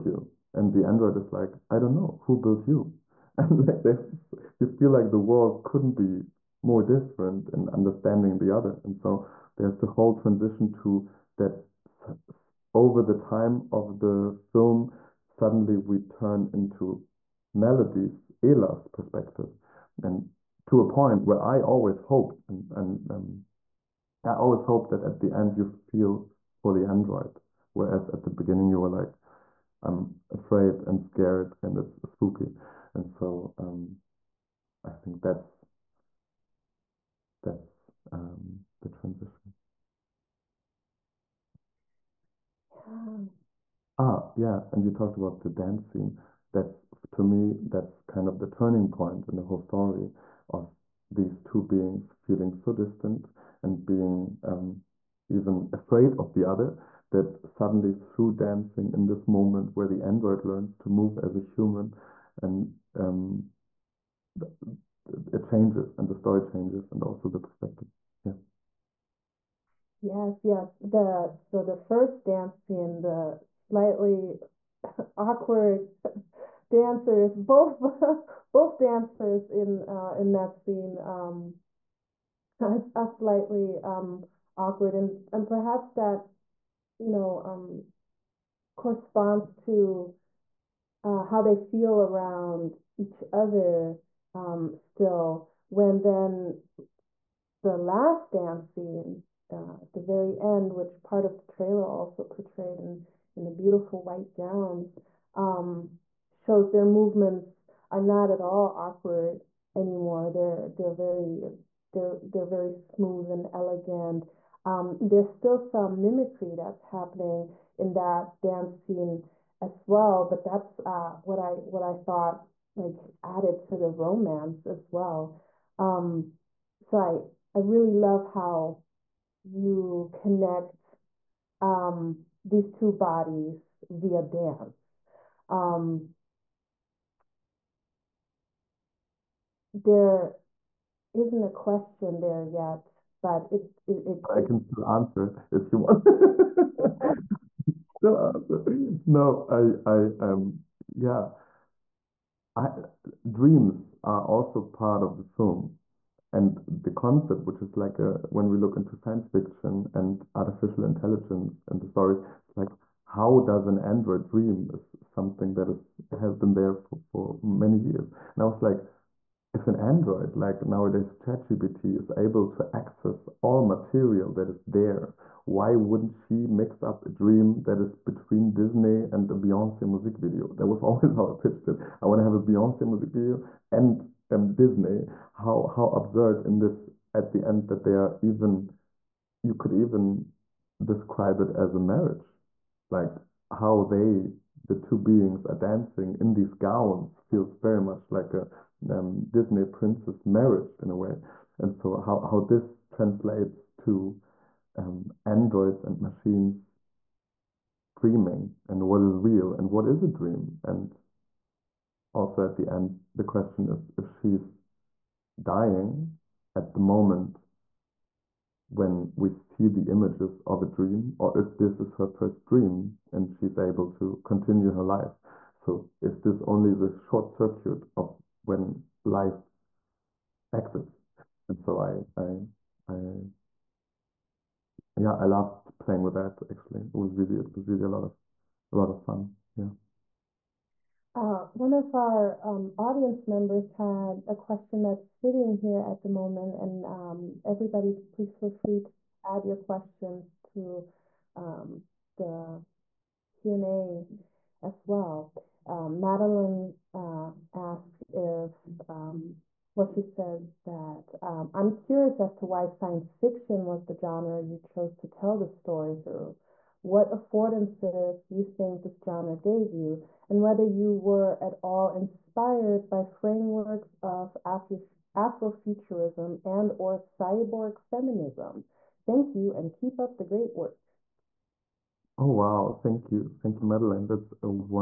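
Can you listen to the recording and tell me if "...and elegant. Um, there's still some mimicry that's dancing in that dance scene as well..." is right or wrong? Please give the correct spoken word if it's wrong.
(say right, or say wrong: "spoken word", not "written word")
wrong: "happening", not "dancing".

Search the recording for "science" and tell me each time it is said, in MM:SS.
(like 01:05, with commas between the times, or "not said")
02:38, 04:22.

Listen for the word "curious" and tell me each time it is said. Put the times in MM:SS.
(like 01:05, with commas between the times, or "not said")
04:21.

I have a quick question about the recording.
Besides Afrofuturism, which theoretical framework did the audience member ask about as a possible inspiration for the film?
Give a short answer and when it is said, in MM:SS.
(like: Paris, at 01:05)
cyborg feminism, at 04:36.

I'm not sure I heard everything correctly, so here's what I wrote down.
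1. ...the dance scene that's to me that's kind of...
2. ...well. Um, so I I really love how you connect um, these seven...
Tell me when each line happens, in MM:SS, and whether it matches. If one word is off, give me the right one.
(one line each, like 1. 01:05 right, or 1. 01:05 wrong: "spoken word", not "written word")
1. 00:45 right
2. 02:04 wrong: "two", not "seven".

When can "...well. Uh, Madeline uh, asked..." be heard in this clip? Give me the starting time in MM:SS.
04:14.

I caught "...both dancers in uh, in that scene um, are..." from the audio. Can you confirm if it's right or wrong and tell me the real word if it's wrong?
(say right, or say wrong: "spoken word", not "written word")
right.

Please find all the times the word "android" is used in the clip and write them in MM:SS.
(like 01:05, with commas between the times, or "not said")
00:00, 00:26, 01:00, 02:43, 02:49, 03:25.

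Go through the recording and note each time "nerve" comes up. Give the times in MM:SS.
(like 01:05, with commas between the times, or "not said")
not said.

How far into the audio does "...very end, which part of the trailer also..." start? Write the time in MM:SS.
01:40.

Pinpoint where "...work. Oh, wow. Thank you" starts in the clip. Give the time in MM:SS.
04:40.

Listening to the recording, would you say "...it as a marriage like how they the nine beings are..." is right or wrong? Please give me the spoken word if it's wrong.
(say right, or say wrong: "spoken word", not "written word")
wrong: "two", not "nine".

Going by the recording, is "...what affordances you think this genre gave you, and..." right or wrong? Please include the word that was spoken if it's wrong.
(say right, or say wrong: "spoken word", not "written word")
right.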